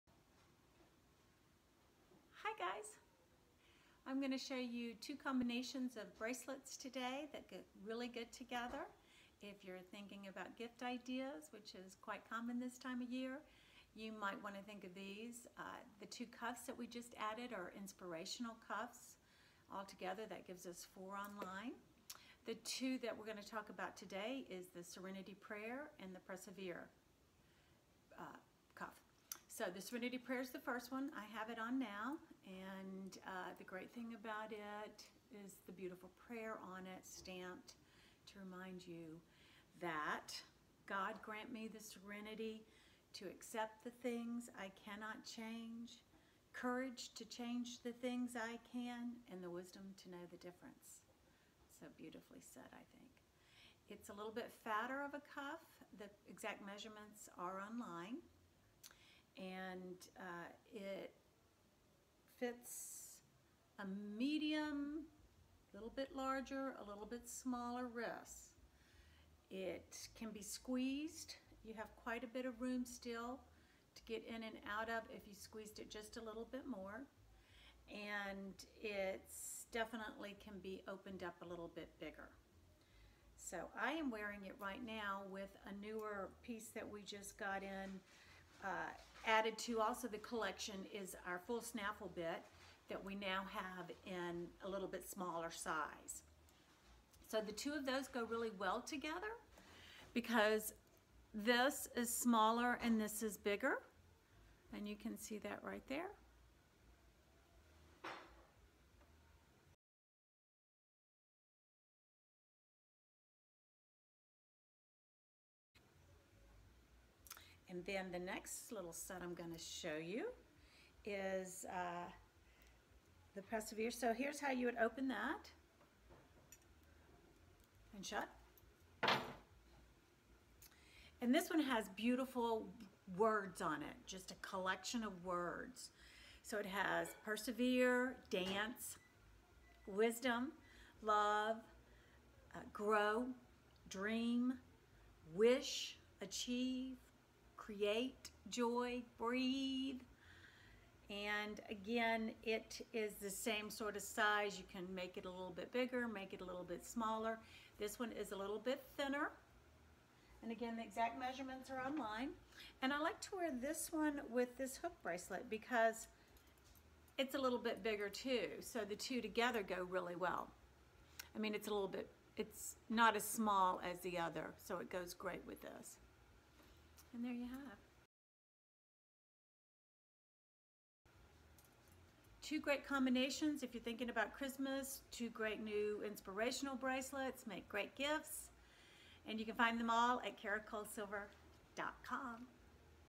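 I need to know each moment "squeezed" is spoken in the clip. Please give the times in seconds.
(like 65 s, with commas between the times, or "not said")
70 s, 75 s.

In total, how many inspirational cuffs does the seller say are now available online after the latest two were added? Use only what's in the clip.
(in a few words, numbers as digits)
4.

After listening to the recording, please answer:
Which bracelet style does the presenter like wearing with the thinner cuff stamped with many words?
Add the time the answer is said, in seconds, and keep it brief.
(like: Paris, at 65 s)
Hook bracelet, at 164 s.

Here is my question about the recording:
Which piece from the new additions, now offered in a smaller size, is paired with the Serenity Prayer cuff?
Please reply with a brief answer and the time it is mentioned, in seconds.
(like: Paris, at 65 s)
Full snaffle bit, at 91 s.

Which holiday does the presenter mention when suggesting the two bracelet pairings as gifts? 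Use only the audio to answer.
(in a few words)
Christmas.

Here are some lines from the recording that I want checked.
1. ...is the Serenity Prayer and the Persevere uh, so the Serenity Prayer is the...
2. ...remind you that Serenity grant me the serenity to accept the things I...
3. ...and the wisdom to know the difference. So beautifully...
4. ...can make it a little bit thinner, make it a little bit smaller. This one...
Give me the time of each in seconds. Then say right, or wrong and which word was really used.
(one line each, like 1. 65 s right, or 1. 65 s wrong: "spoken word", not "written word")
1. 24 s right
2. 38 s wrong: "God", not "Serenity"
3. 49 s right
4. 154 s wrong: "bigger", not "thinner".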